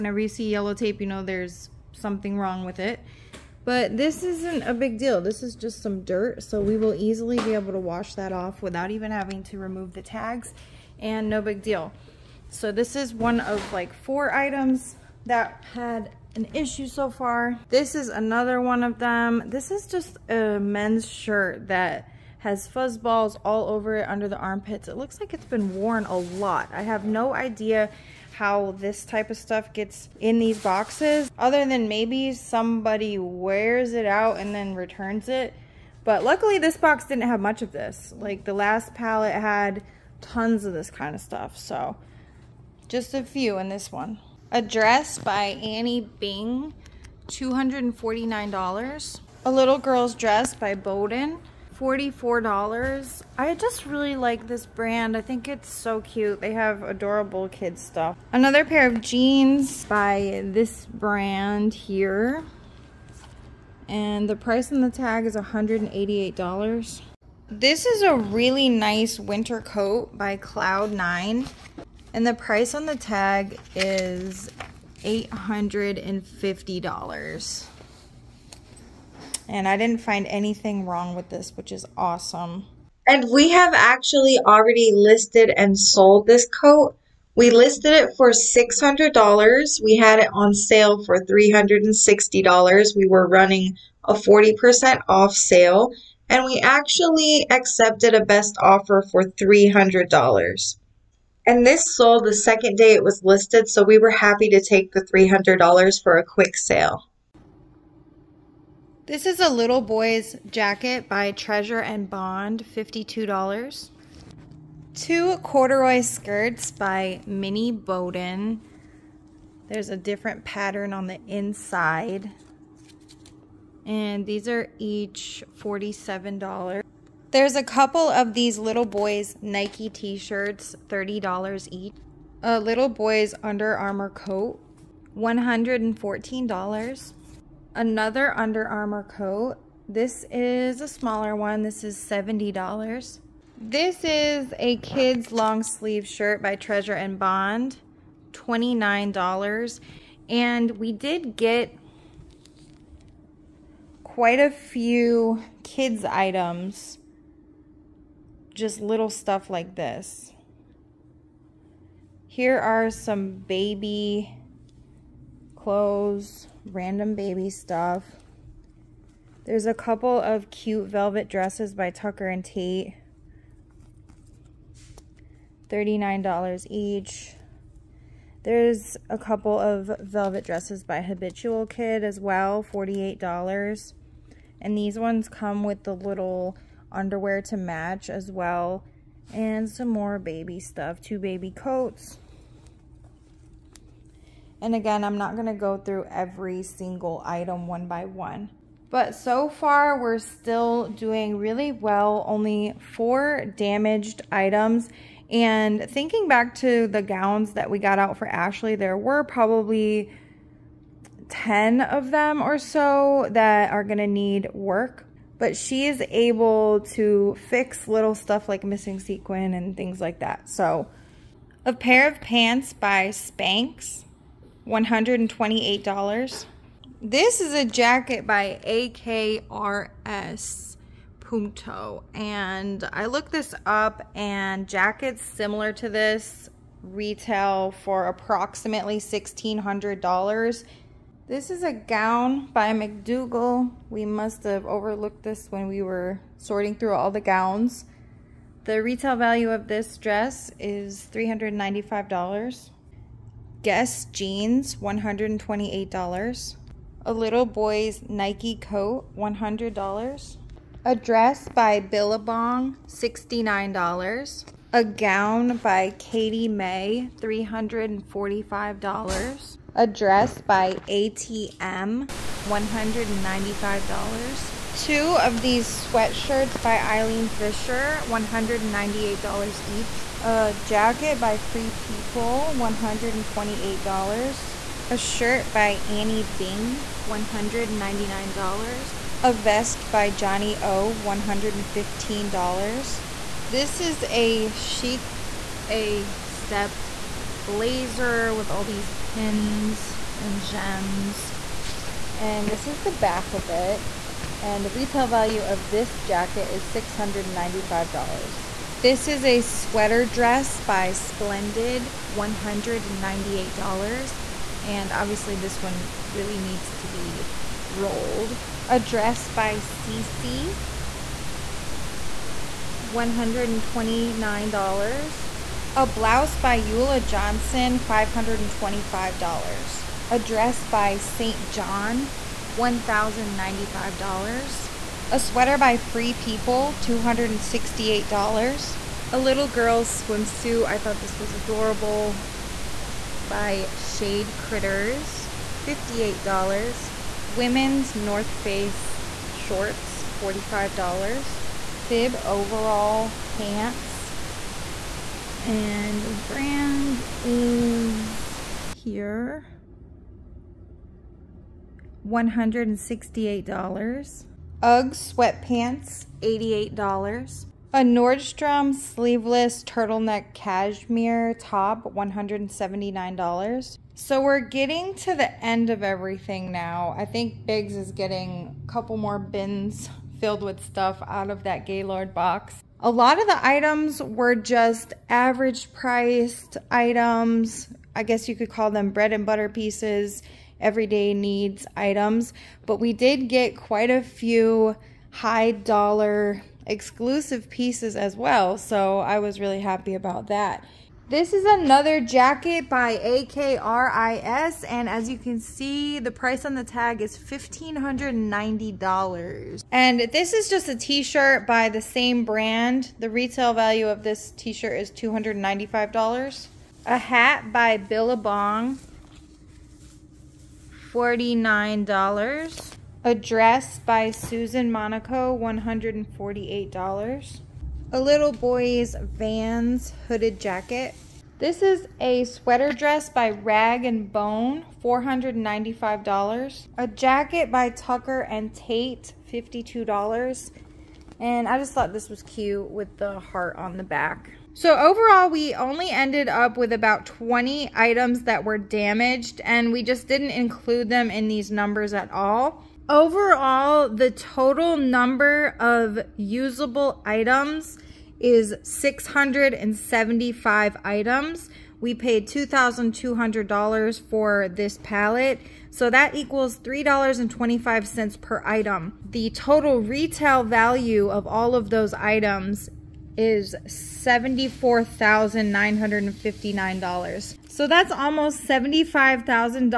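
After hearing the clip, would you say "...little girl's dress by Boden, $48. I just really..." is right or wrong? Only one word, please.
wrong.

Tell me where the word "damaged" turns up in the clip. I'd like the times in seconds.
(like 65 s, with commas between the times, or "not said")
203 s, 448 s.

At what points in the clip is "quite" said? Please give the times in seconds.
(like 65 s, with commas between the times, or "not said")
154 s, 393 s.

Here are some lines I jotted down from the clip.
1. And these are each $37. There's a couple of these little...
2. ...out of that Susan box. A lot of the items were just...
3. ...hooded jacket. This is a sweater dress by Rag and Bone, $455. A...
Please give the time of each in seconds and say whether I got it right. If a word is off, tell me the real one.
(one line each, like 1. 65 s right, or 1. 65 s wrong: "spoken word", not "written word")
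1. 123 s wrong: "47", not "37"
2. 381 s wrong: "Gaylord", not "Susan"
3. 430 s wrong: "495", not "455".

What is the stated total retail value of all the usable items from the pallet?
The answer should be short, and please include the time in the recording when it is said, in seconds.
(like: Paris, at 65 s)
$74,959, at 473 s.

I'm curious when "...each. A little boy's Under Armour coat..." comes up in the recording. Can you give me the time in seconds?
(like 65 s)
131 s.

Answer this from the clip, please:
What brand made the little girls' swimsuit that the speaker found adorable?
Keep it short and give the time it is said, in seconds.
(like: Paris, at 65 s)
Shade Critters, at 343 s.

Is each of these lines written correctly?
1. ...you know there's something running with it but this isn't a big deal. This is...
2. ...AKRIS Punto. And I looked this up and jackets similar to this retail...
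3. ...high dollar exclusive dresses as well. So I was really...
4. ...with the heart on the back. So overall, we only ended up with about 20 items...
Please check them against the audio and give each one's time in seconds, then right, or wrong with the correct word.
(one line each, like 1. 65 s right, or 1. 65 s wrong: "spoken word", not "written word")
1. 1 s wrong: "wrong", not "running"
2. 228 s right
3. 395 s wrong: "pieces", not "dresses"
4. 442 s right.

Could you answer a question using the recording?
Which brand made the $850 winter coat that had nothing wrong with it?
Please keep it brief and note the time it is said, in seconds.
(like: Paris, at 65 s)
Cloud9, at 70 s.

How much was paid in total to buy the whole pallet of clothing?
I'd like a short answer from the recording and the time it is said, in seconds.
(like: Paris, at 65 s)
$2,200, at 461 s.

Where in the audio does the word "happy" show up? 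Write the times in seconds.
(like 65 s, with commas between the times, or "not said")
104 s, 399 s.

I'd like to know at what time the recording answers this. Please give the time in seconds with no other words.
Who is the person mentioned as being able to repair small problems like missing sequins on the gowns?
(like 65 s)
208 s.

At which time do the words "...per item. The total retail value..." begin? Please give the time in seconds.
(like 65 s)
468 s.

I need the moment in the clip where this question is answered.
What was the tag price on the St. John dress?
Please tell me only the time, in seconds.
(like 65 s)
332 s.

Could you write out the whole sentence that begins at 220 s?
So a pair of pants by Spanx $128.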